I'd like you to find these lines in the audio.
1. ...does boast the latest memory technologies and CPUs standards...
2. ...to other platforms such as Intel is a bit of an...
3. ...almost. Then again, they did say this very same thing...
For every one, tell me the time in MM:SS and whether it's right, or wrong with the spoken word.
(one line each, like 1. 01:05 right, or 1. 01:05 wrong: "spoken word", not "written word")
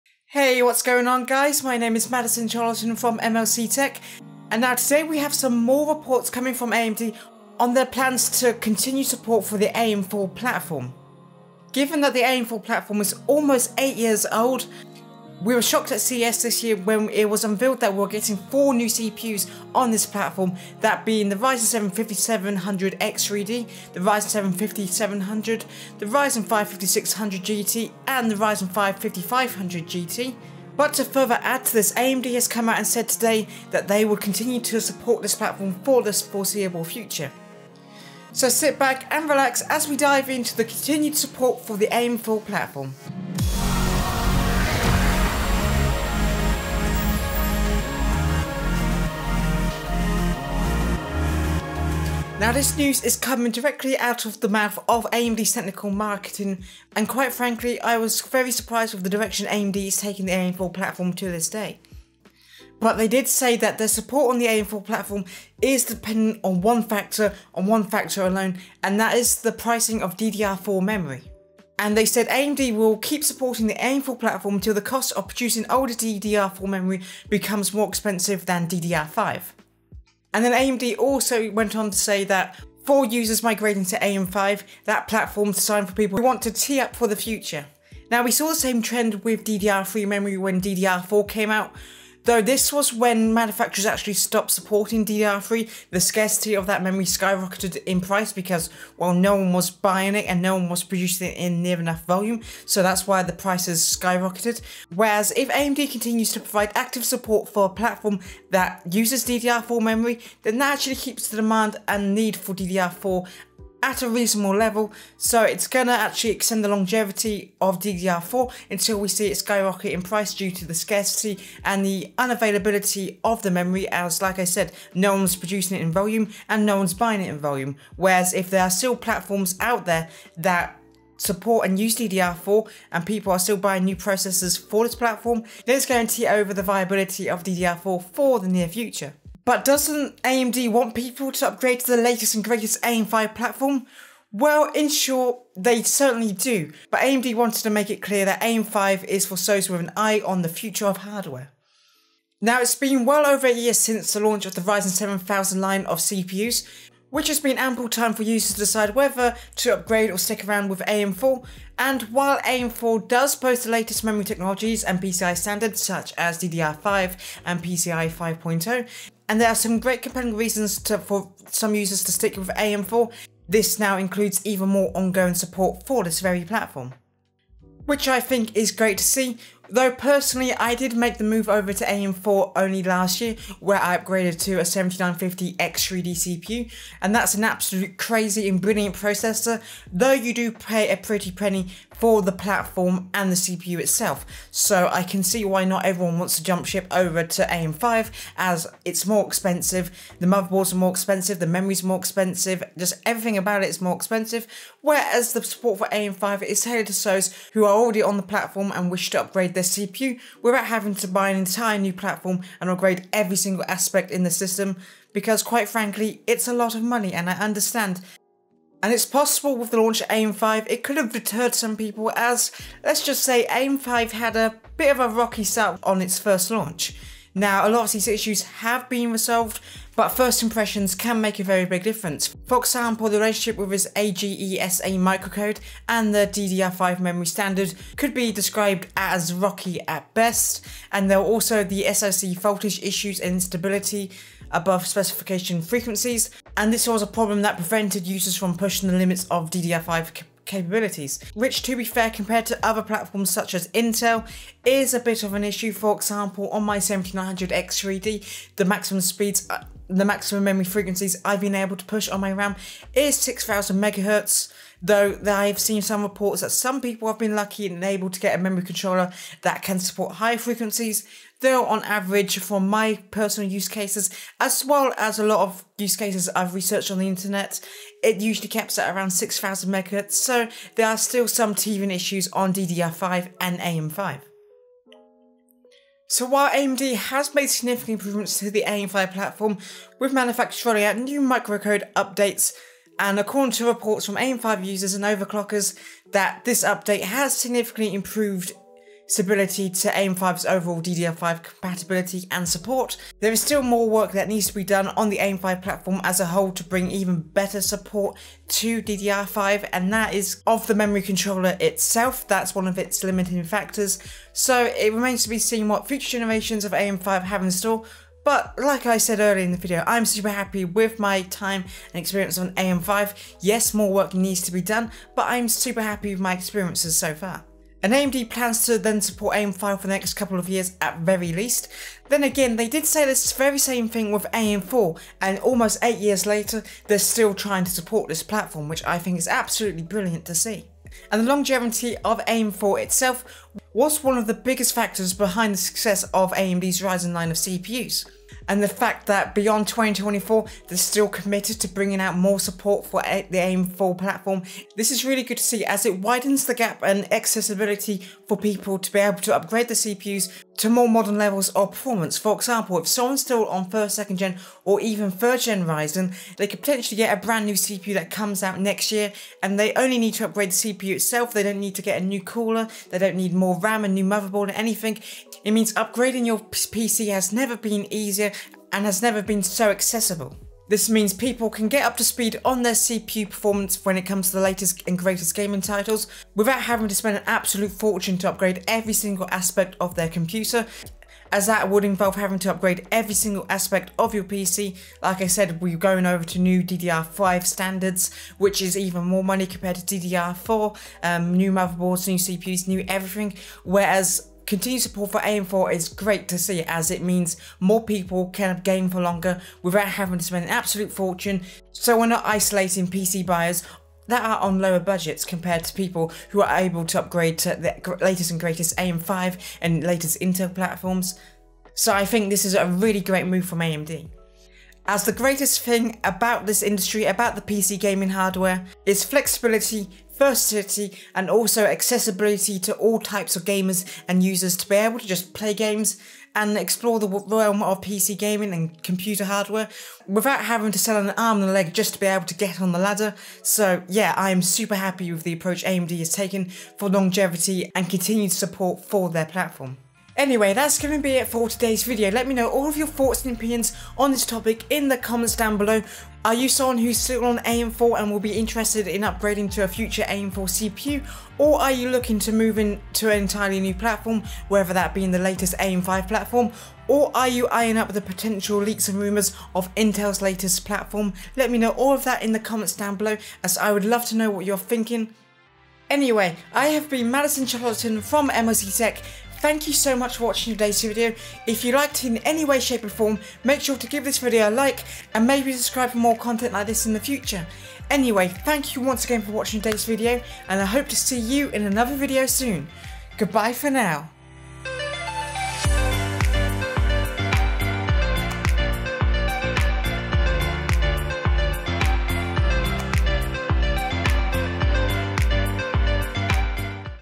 1. 02:43 wrong: "PCI", not "CPUs"
2. 04:12 right
3. 05:31 wrong: "least", not "almost".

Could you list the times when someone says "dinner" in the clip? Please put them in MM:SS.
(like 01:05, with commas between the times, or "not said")
not said.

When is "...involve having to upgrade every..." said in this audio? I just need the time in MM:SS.
06:31.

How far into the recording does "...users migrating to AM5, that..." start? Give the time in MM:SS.
01:23.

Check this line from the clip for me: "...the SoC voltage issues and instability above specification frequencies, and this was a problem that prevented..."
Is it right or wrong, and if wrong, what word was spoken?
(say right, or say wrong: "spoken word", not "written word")
right.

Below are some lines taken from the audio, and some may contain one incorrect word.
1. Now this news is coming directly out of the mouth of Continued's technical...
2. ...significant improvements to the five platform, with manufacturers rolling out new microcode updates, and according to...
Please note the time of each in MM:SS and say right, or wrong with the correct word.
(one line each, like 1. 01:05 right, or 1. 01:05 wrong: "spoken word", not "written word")
1. 00:52 wrong: "AMD", not "Continued"
2. 04:47 right.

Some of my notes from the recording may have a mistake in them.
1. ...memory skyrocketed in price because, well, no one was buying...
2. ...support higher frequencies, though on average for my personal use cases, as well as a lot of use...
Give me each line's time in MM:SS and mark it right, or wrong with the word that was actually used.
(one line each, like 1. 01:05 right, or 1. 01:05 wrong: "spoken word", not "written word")
1. 01:36 right
2. 04:29 right.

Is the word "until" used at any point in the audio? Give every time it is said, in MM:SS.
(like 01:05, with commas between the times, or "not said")
01:14, 01:58.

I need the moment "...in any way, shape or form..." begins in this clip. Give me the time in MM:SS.
08:02.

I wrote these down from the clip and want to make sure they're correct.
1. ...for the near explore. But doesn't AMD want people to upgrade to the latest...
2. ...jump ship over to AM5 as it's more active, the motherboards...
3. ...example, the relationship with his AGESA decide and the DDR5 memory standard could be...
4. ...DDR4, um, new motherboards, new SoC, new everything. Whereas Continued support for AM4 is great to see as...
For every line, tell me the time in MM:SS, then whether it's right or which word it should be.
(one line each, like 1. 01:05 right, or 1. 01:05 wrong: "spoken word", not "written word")
1. 02:18 wrong: "future", not "explore"
2. 03:16 wrong: "expensive", not "active"
3. 03:52 wrong: "microcode", not "decide"
4. 06:39 wrong: "CPUs", not "SoC".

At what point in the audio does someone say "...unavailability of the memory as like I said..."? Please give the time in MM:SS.
02:02.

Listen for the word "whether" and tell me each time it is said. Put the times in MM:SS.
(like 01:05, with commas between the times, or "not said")
02:38, 07:44.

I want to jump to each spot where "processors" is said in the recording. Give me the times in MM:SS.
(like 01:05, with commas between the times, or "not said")
02:13, 03:08.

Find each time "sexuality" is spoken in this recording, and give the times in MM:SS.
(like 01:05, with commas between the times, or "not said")
not said.